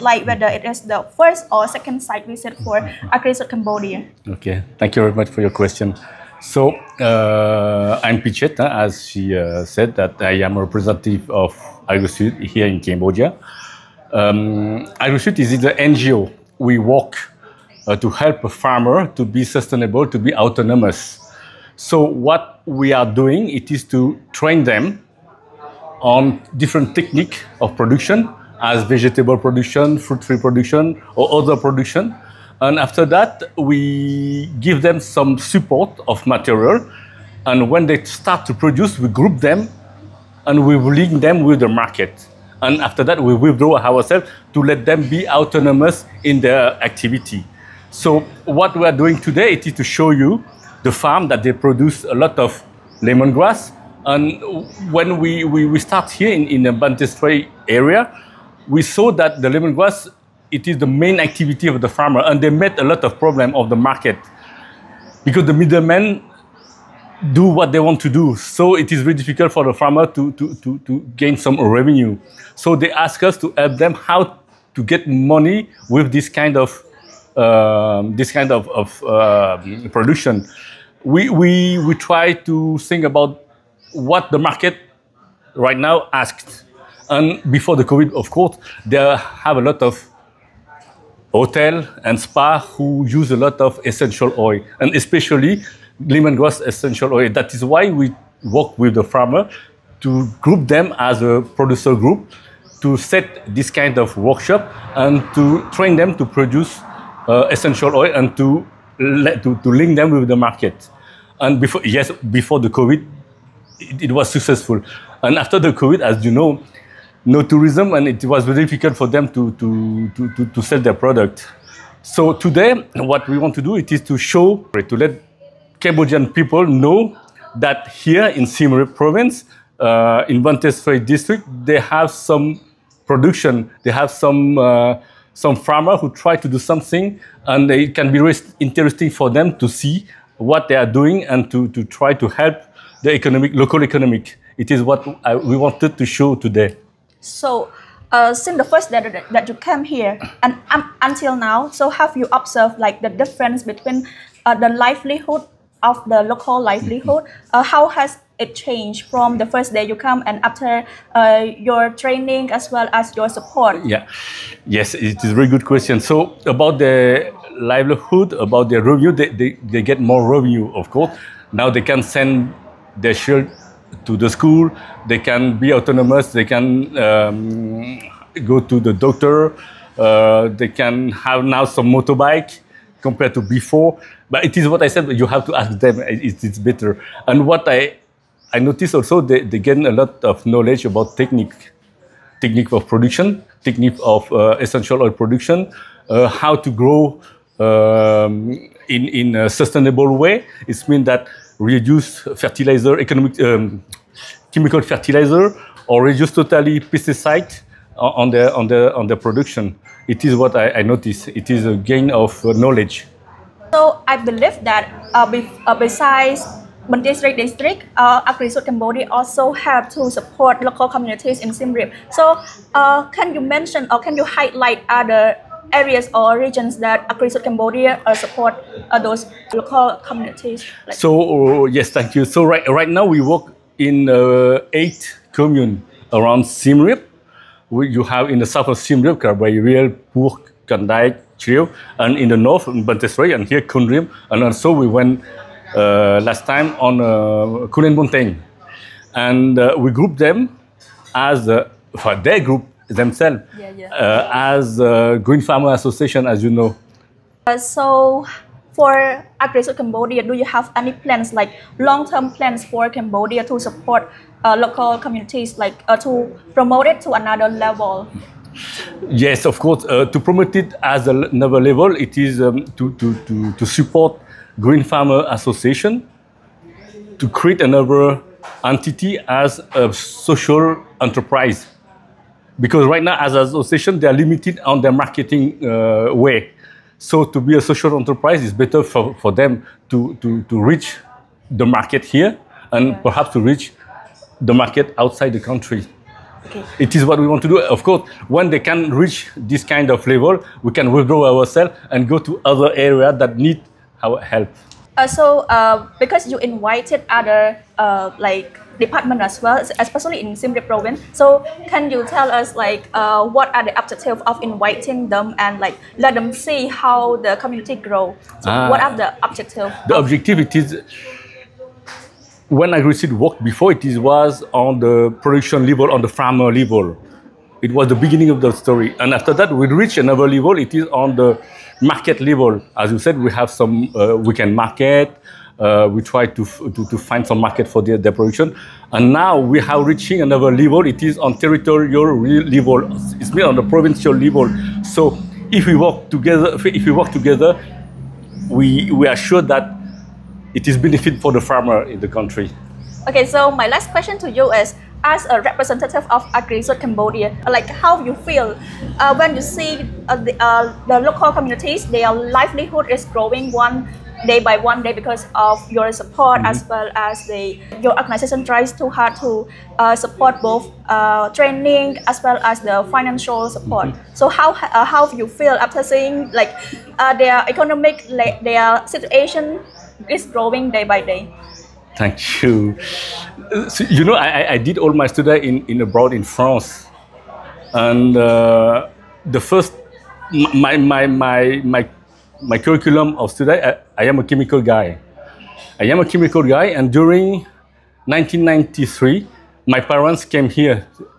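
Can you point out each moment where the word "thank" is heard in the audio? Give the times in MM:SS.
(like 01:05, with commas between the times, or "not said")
00:04, 03:51, 06:21.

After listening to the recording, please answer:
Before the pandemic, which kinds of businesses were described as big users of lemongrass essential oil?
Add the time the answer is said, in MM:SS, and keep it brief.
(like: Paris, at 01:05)
Hotel and spa, at 01:31.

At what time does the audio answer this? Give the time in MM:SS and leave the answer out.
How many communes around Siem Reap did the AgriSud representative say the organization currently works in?
03:54.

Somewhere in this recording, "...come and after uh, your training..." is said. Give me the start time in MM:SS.
02:39.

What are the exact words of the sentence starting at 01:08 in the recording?
So it is very difficult for the farmer to, to, to, to gain some revenue.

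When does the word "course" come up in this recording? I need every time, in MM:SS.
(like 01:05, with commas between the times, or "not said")
01:28, 02:50, 04:29, 04:57.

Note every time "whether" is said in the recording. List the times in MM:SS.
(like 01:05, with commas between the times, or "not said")
00:00.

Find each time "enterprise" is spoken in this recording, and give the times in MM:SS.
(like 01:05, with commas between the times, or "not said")
04:40, 04:47.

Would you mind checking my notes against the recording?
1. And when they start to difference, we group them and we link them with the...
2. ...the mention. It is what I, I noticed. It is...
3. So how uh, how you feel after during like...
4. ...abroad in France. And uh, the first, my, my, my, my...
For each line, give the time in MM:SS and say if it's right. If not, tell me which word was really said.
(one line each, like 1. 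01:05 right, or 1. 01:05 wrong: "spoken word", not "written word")
1. 00:37 wrong: "produce", not "difference"
2. 03:29 wrong: "production", not "mention"
3. 06:14 wrong: "seeing", not "during"
4. 06:25 right.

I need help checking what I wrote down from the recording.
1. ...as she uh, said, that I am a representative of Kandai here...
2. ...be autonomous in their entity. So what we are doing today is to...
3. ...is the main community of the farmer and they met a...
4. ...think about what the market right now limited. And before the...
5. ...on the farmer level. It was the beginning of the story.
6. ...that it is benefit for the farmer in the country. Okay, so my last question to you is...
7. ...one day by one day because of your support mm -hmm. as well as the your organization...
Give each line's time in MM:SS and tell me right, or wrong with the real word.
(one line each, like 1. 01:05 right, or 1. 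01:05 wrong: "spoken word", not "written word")
1. 00:08 wrong: "AgriSud", not "Kandai"
2. 00:45 wrong: "activity", not "entity"
3. 01:00 wrong: "activity", not "community"
4. 01:22 wrong: "asked", not "limited"
5. 05:25 right
6. 05:49 right
7. 06:03 right.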